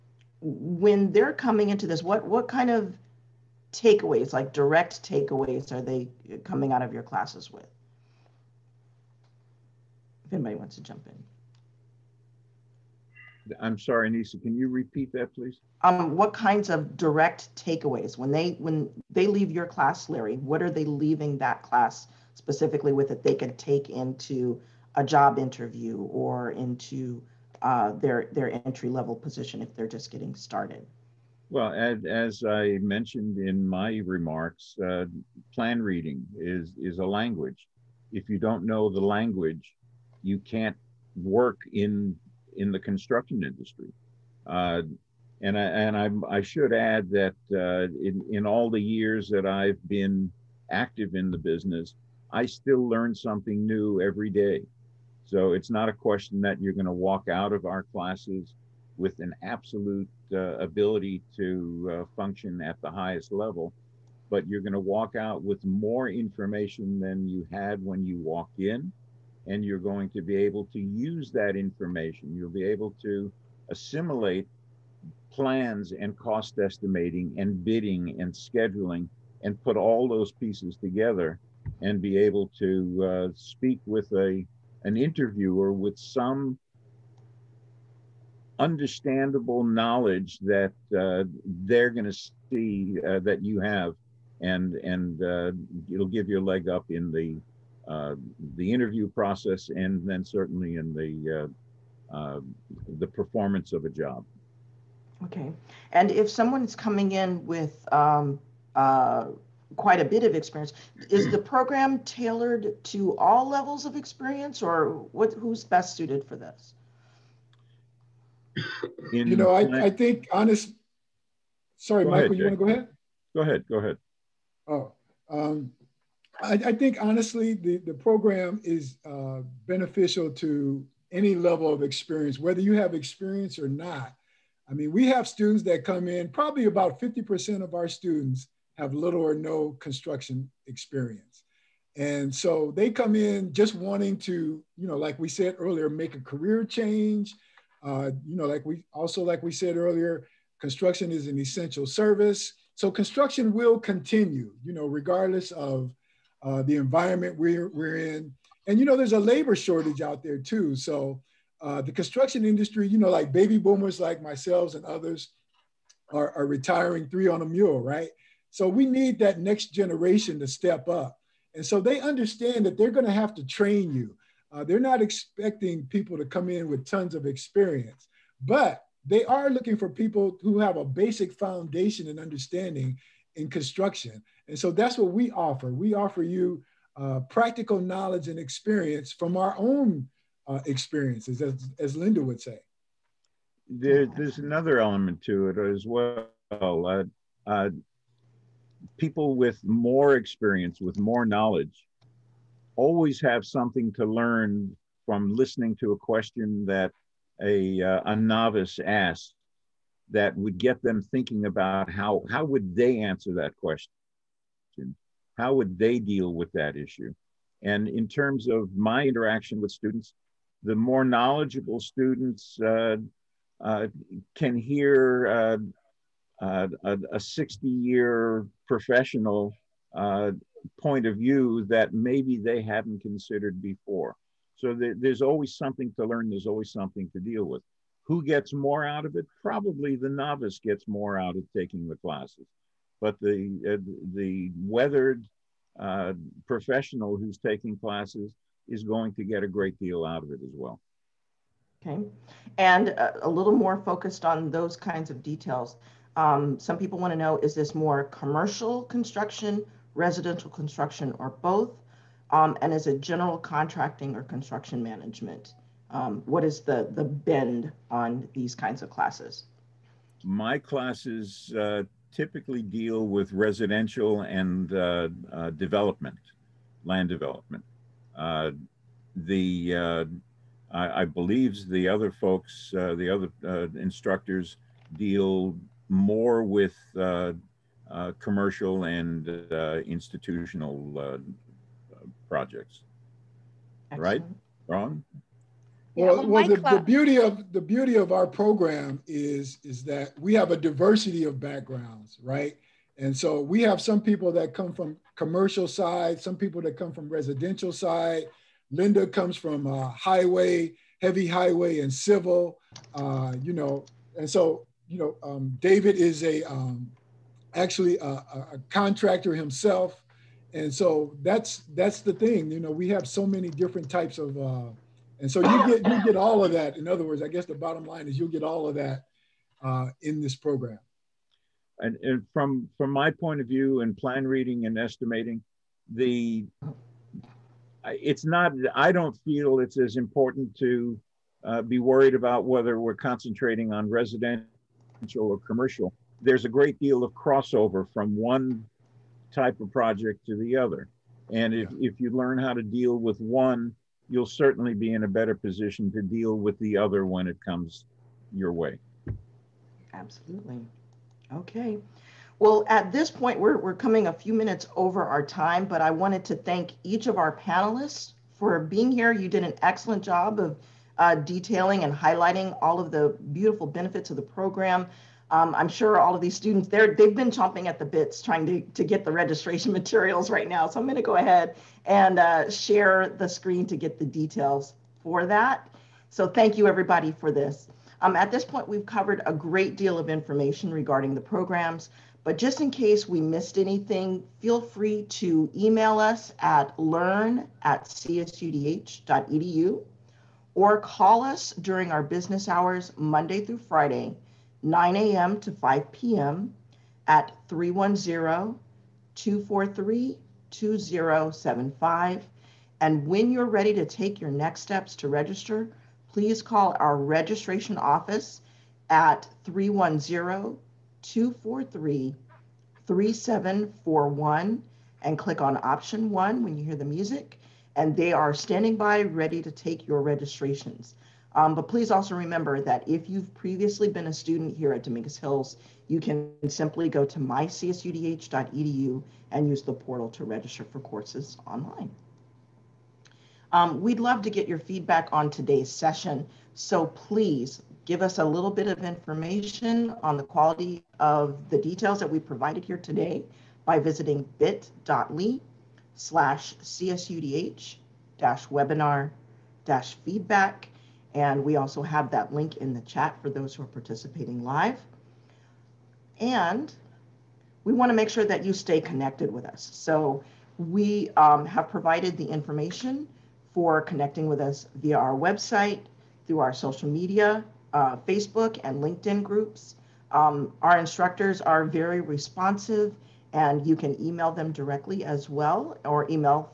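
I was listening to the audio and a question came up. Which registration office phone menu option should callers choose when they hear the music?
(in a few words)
option one.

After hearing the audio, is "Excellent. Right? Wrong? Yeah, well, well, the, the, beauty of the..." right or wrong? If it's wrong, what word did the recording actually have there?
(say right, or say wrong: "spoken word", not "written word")
right.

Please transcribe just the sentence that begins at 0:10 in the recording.
If anybody wants to jump in.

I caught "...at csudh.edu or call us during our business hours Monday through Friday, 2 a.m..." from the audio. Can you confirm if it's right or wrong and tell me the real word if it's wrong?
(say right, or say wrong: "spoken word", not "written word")
wrong: "9", not "2".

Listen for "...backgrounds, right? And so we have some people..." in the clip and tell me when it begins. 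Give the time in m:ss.
5:01.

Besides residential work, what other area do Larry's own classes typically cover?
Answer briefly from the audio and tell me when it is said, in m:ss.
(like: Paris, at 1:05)
land development, at 4:36.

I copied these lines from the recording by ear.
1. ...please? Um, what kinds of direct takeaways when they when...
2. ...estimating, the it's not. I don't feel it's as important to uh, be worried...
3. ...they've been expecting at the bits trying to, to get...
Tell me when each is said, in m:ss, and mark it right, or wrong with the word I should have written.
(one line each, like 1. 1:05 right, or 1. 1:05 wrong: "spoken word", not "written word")
1. 0:15 right
2. 5:34 right
3. 6:16 wrong: "chomping", not "expecting".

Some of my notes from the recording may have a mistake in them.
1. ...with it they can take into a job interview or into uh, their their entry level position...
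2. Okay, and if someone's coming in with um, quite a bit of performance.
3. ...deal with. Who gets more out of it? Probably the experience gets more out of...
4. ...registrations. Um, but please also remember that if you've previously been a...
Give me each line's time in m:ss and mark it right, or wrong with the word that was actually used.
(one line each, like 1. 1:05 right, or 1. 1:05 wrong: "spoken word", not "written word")
1. 0:22 right
2. 1:45 wrong: "experience", not "performance"
3. 3:57 wrong: "novice", not "experience"
4. 7:10 right.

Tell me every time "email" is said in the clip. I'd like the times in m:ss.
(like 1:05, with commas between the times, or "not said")
6:35, 8:03.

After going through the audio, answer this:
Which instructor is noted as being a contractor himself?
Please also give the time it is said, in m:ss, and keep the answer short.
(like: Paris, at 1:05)
David, at 5:15.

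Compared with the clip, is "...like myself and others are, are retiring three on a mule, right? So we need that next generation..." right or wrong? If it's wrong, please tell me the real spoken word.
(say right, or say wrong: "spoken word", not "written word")
right.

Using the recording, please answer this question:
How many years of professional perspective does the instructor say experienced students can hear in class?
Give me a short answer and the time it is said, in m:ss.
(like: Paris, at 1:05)
60, at 3:47.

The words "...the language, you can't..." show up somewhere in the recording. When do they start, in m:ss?
0:38.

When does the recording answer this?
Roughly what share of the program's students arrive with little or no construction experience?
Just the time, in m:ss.
2:16.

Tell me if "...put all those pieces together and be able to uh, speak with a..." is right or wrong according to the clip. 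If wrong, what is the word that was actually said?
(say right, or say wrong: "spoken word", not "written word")
right.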